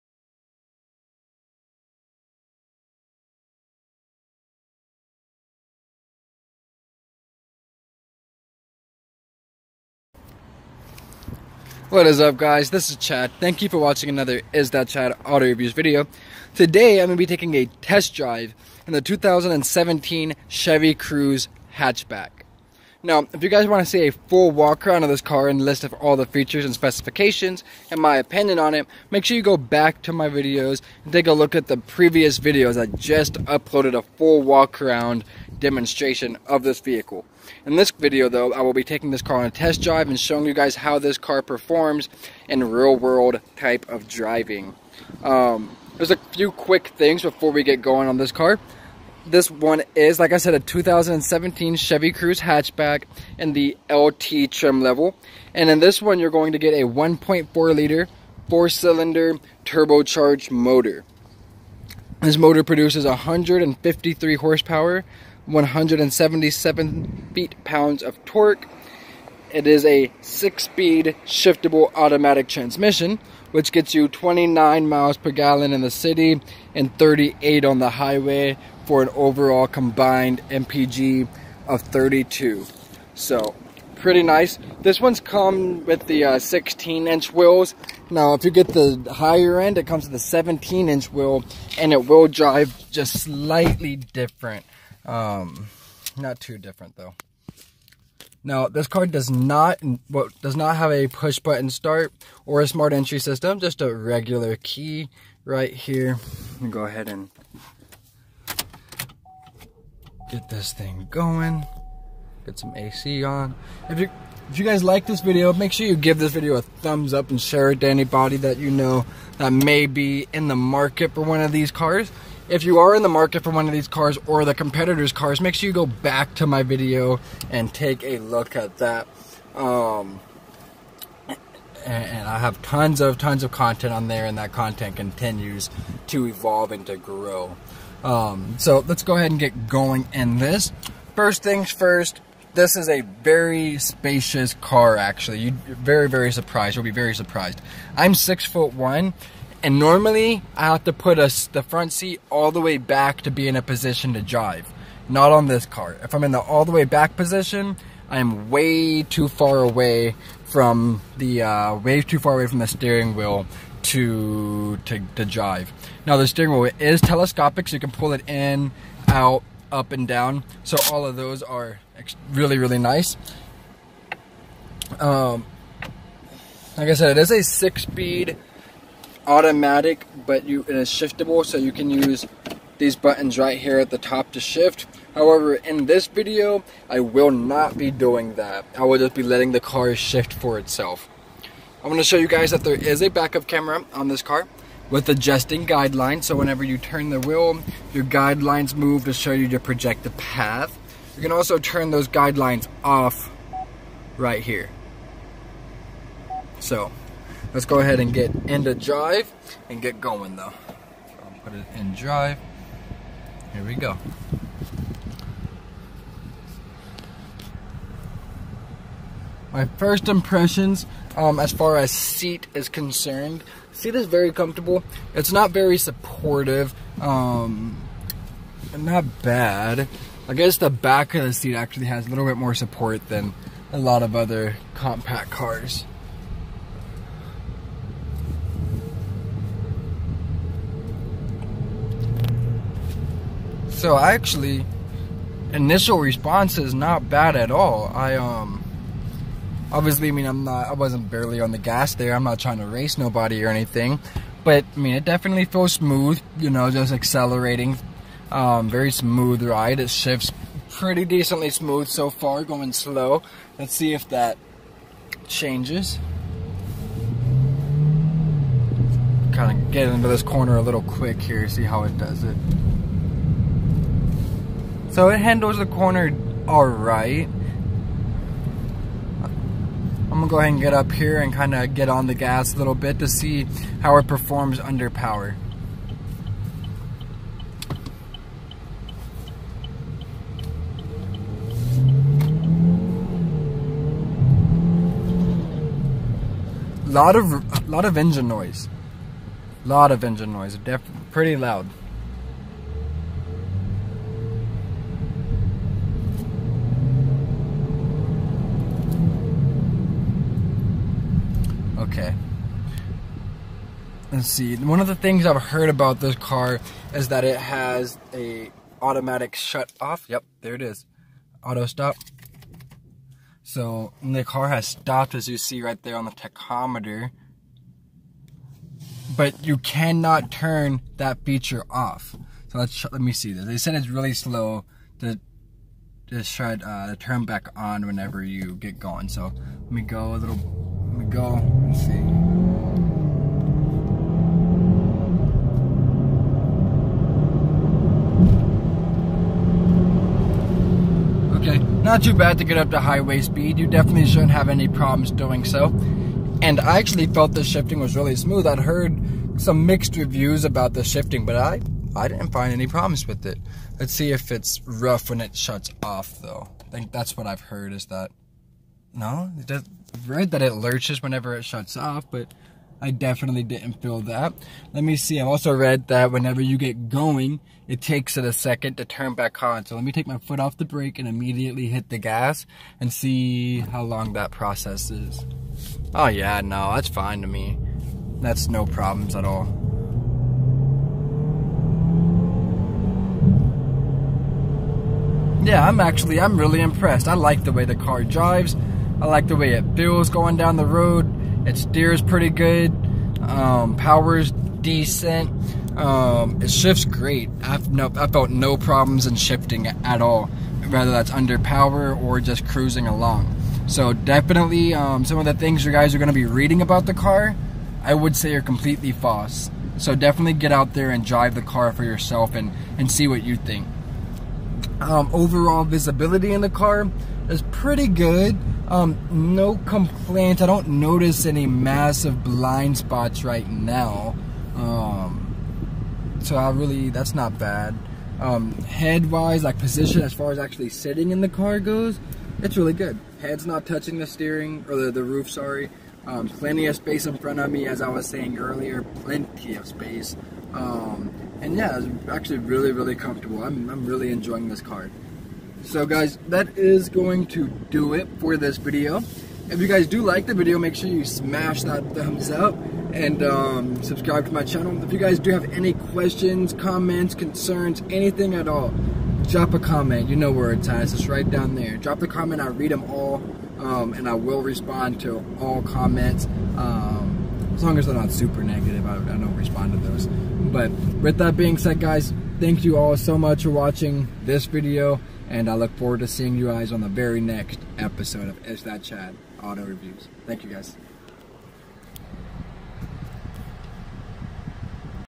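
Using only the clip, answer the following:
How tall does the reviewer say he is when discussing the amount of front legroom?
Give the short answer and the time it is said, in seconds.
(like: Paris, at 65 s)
6 foot 1, at 148 s.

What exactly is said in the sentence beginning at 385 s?
Oh yeah, no, that's fine to me.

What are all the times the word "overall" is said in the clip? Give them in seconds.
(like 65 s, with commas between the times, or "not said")
79 s, 425 s.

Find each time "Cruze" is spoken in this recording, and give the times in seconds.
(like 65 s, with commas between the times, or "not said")
20 s, 52 s.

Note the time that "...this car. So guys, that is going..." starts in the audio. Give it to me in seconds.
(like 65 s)
454 s.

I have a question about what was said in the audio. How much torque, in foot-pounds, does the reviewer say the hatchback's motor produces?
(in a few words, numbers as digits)
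177.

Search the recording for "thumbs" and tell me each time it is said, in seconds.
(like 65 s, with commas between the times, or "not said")
116 s, 461 s.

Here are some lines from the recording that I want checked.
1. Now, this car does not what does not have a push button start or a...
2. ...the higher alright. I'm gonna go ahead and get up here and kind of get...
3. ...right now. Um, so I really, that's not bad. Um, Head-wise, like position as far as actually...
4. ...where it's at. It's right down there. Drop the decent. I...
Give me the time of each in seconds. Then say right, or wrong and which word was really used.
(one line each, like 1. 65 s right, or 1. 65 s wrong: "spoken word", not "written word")
1. 98 s right
2. 275 s wrong: "corner", not "higher"
3. 433 s right
4. 470 s wrong: "comment", not "decent".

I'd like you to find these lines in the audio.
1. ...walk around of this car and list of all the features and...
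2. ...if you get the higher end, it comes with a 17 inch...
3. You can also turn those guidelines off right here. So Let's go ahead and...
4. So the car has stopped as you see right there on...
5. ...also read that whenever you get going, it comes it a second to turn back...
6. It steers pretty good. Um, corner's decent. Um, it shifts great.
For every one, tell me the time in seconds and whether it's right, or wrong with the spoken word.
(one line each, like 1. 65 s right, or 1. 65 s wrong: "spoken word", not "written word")
1. 24 s right
2. 88 s right
3. 201 s right
4. 323 s right
5. 375 s wrong: "takes", not "comes"
6. 401 s wrong: "power", not "corner".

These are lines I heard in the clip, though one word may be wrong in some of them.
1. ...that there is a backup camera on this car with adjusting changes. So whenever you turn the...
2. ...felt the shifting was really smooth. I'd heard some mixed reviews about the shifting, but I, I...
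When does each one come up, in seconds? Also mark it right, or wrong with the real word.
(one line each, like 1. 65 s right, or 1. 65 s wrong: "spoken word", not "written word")
1. 192 s wrong: "guidelines", not "changes"
2. 357 s right.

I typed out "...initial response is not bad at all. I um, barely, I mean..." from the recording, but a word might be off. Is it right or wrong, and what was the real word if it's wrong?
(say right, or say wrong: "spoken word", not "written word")
wrong: "obviously", not "barely".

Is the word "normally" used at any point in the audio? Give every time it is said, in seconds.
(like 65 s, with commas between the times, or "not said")
149 s.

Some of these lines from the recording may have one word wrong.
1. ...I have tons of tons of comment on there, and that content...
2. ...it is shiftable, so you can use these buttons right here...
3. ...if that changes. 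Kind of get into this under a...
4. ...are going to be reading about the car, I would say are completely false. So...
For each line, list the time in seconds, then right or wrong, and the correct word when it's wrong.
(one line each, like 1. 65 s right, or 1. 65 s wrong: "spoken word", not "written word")
1. 132 s wrong: "content", not "comment"
2. 180 s right
3. 263 s wrong: "corner", not "under"
4. 415 s right.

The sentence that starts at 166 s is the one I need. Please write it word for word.
Now the steering wheel is telescopic, so you can pull it in, out, up, and down.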